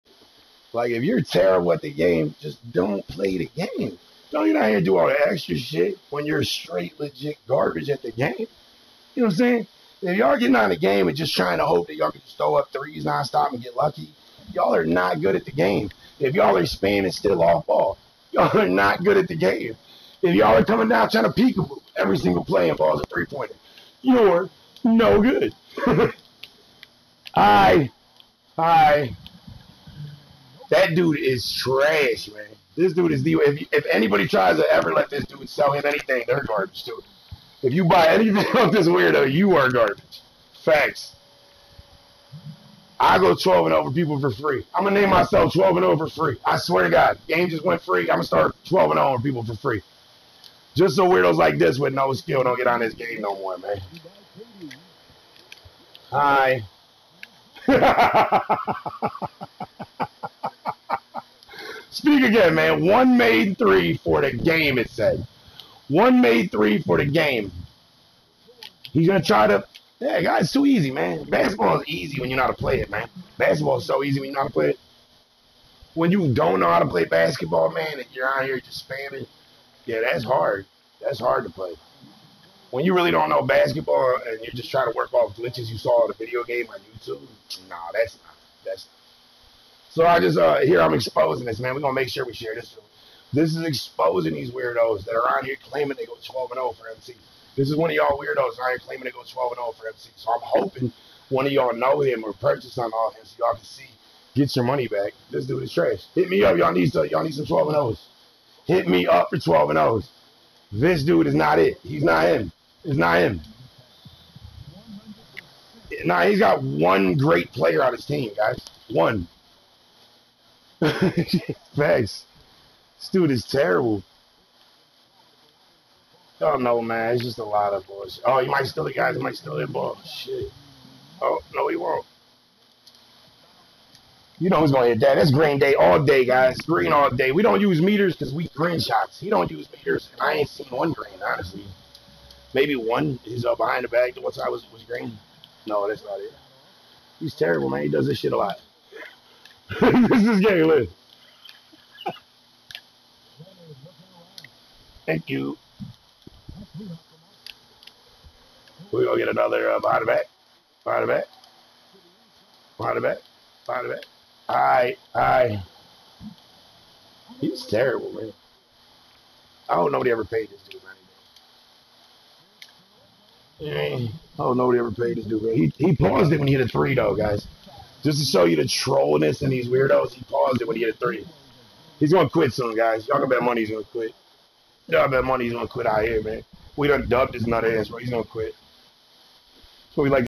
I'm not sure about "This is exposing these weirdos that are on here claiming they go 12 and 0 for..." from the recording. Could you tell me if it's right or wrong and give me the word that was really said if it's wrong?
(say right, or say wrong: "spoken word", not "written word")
right.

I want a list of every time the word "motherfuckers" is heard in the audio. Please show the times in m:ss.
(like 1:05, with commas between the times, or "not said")
not said.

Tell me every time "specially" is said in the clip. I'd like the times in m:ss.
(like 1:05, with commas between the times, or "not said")
not said.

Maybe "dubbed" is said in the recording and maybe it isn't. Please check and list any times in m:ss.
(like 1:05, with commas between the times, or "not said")
3:07.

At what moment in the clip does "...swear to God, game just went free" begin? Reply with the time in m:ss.
0:46.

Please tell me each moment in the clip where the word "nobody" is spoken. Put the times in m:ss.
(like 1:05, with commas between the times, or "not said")
2:49, 2:54.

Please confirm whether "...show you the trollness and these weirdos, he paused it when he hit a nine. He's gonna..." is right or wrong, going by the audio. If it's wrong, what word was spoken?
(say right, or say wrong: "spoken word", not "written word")
wrong: "three", not "nine".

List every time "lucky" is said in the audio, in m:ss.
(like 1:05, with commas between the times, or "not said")
0:13.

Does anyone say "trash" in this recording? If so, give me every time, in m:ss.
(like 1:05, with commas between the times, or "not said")
0:31, 1:45.